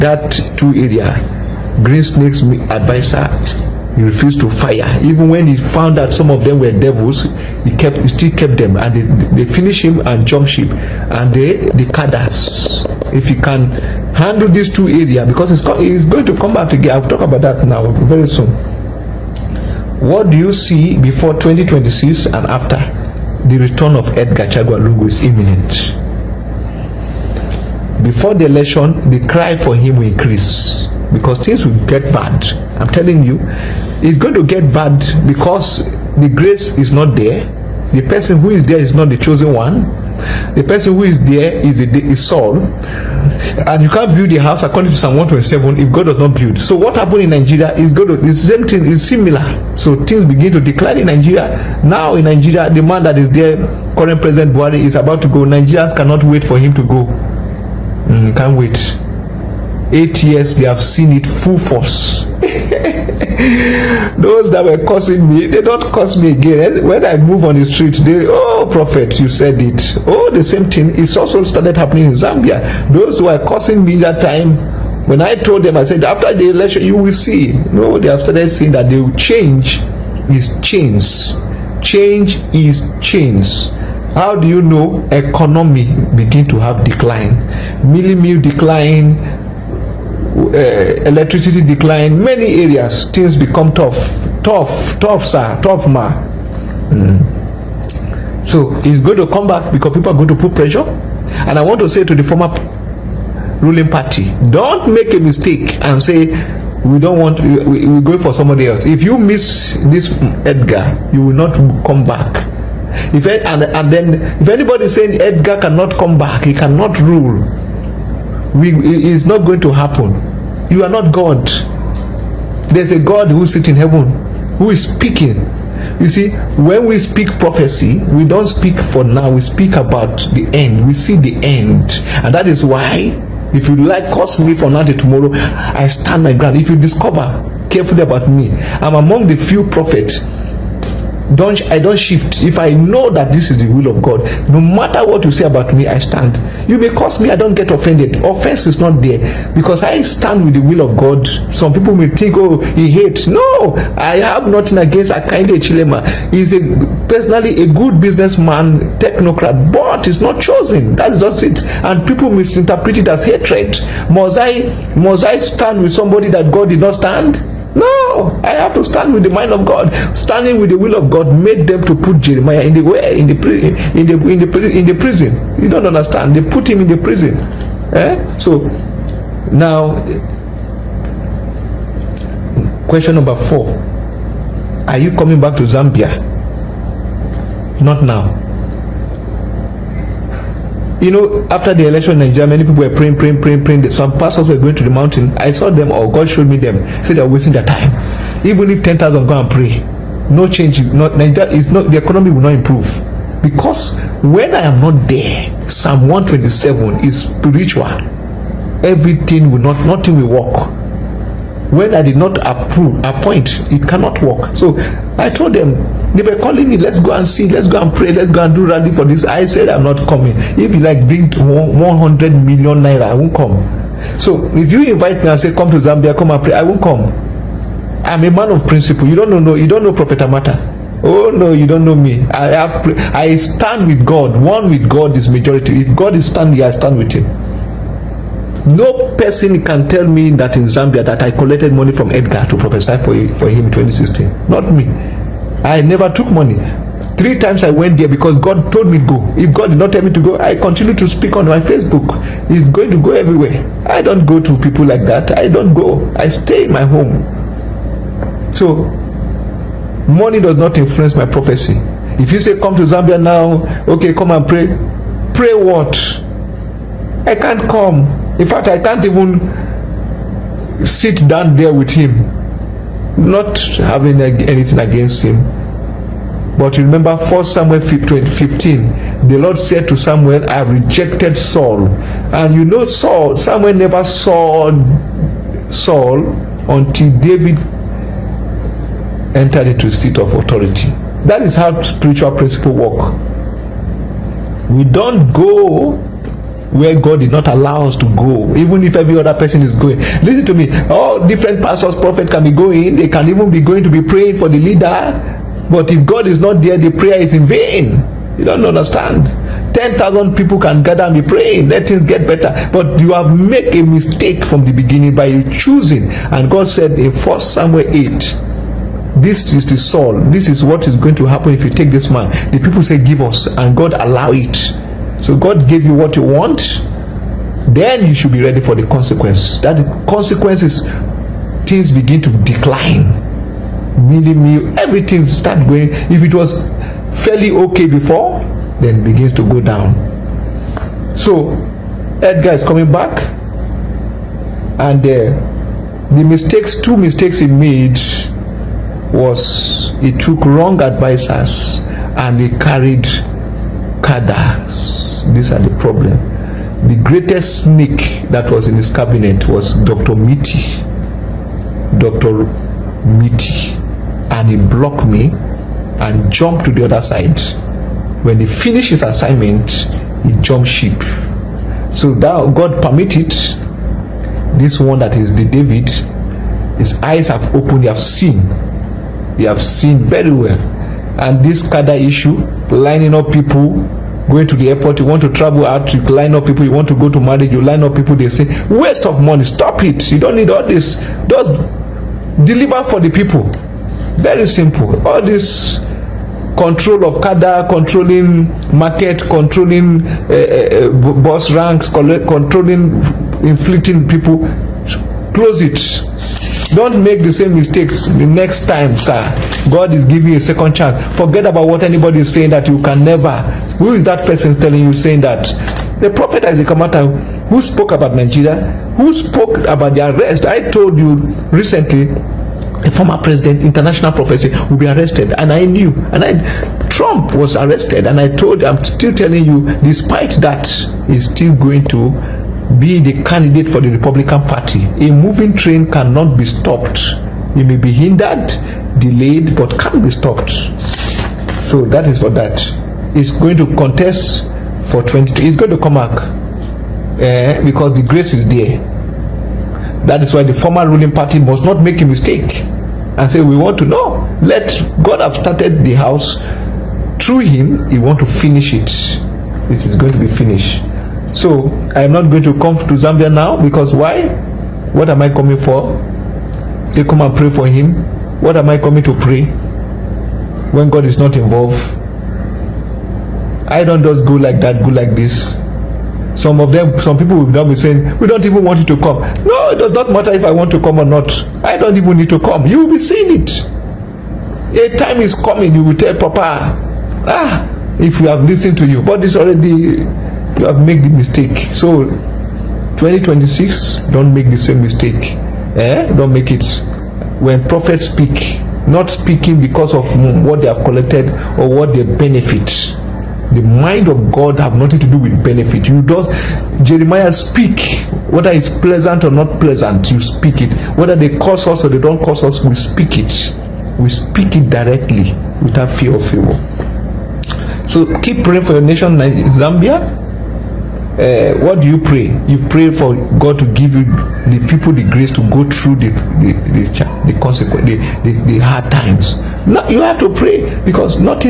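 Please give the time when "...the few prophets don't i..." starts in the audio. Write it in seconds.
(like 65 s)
139 s.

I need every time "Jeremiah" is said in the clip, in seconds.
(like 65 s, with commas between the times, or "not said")
172 s, 506 s.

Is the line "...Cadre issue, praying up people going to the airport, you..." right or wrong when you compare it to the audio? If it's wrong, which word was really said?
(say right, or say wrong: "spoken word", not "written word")
wrong: "lining", not "praying".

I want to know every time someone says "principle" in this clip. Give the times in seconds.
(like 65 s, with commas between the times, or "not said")
228 s, 292 s.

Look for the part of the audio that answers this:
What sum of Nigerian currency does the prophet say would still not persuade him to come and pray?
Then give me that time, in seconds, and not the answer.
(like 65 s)
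221 s.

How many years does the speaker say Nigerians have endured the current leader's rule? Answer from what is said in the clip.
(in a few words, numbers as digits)
8.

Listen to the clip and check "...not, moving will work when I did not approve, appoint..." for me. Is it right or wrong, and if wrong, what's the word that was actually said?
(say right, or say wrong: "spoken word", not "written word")
wrong: "nothing", not "moving".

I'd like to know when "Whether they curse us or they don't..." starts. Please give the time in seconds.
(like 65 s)
510 s.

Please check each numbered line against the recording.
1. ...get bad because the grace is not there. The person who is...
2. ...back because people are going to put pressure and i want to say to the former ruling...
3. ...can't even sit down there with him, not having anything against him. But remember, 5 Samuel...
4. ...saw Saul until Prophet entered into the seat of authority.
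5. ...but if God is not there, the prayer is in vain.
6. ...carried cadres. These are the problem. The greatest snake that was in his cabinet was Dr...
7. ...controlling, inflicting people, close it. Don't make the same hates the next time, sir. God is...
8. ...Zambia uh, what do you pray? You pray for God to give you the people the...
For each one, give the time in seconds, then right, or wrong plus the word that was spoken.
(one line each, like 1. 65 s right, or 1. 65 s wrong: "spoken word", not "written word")
1. 34 s right
2. 99 s right
3. 268 s wrong: "1", not "5"
4. 284 s wrong: "David", not "Prophet"
5. 305 s right
6. 352 s right
7. 401 s wrong: "mistakes", not "hates"
8. 519 s right.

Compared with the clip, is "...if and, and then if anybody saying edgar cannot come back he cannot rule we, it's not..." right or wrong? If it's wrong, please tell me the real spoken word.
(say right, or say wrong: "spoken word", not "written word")
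right.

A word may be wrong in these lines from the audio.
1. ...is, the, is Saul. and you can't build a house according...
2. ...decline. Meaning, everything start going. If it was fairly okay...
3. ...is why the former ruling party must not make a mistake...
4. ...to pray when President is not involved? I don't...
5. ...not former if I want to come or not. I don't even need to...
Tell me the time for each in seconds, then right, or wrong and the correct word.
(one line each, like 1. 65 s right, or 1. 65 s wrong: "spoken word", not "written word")
1. 41 s right
2. 332 s right
3. 450 s right
4. 469 s wrong: "God", not "President"
5. 479 s wrong: "matter", not "former".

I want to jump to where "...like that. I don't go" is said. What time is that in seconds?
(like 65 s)
254 s.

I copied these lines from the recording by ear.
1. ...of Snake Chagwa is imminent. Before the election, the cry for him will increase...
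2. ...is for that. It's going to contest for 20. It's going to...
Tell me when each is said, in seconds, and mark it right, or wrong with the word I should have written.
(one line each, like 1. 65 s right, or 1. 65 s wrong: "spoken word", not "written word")
1. 23 s wrong: "Edgar", not "Snake"
2. 442 s right.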